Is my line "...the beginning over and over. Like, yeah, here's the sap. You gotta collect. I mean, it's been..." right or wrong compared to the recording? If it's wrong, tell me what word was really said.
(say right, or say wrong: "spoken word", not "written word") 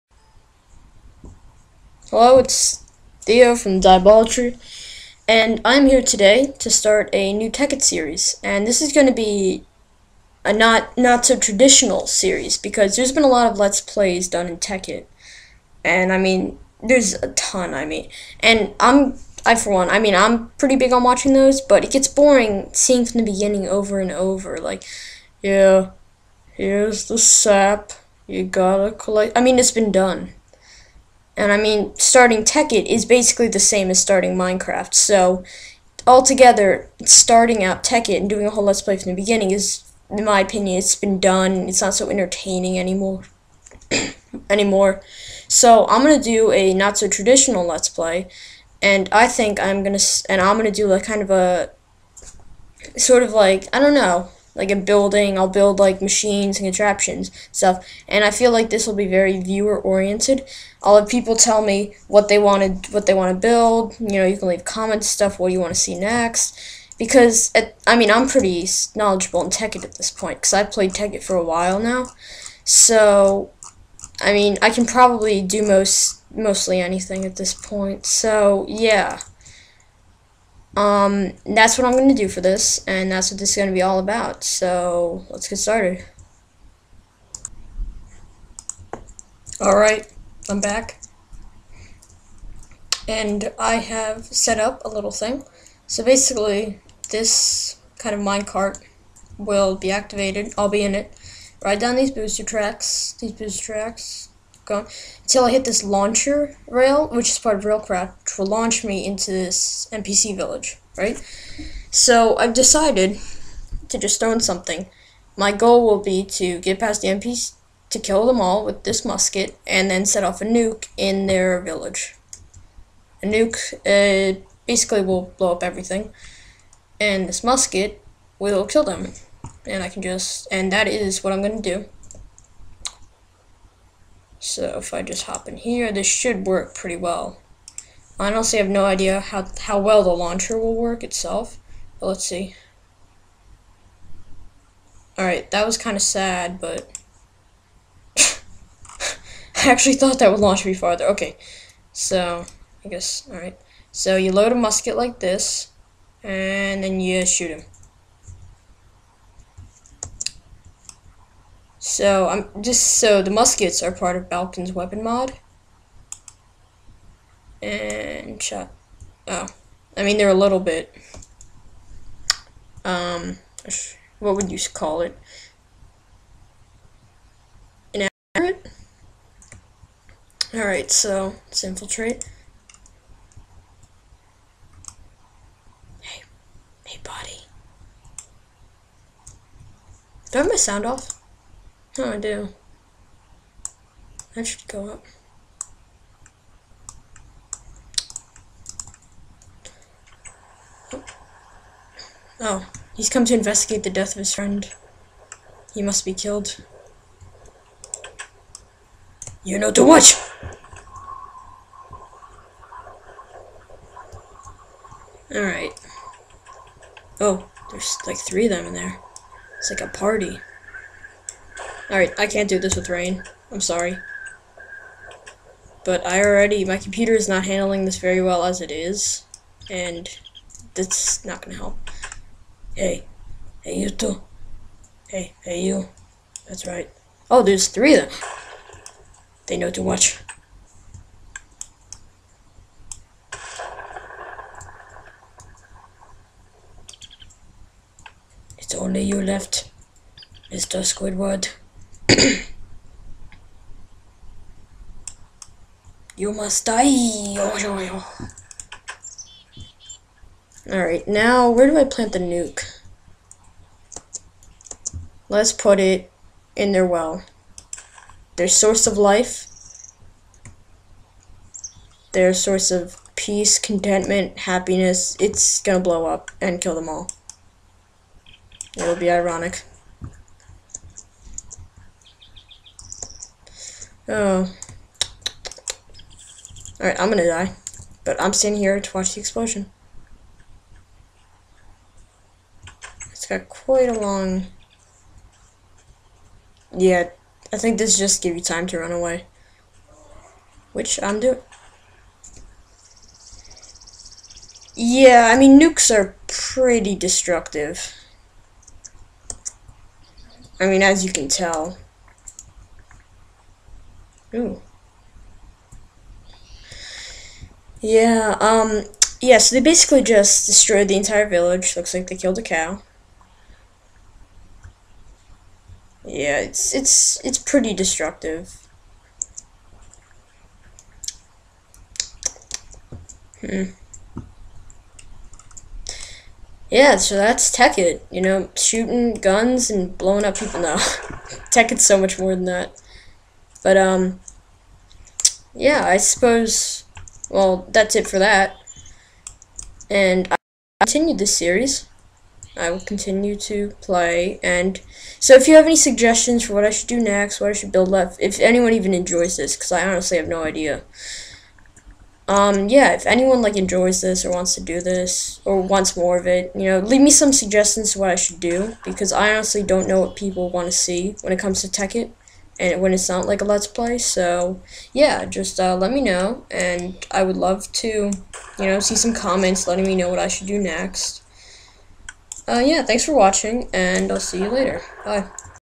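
right.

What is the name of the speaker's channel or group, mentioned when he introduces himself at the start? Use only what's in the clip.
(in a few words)
Diabolatry.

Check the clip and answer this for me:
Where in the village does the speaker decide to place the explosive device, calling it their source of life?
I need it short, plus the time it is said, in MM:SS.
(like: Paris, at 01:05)
their well, at 04:26.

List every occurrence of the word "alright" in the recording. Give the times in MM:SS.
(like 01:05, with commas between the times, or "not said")
01:29, 02:25, 02:33, 03:35, 03:41, 04:20, 04:46.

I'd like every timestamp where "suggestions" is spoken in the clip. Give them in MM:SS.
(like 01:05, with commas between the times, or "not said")
05:55, 06:07.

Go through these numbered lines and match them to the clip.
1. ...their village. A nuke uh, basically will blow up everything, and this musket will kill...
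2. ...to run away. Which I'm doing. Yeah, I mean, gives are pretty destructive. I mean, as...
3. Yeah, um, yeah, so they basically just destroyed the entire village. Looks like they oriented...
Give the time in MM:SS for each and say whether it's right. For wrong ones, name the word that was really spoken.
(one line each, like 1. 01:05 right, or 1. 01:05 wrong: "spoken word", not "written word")
1. 02:01 right
2. 04:58 wrong: "nukes", not "gives"
3. 05:17 wrong: "killed", not "oriented".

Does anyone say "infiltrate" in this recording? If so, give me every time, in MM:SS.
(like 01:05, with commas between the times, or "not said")
03:01.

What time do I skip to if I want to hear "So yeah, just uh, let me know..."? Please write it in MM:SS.
06:13.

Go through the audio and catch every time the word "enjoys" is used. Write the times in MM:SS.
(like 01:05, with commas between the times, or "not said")
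05:58, 06:03.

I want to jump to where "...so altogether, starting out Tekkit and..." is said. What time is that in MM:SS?
00:34.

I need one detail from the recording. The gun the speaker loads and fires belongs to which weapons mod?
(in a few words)
Balkon's weapon mod.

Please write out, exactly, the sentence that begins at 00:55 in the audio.
I'll build like machines and contraptions stuff.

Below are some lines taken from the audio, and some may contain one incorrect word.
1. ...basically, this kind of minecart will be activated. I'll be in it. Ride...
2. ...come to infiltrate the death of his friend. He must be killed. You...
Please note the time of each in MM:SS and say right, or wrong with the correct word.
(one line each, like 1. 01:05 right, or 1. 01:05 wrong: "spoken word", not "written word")
1. 01:36 right
2. 03:23 wrong: "investigate", not "infiltrate".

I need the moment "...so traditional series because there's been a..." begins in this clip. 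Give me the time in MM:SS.
00:11.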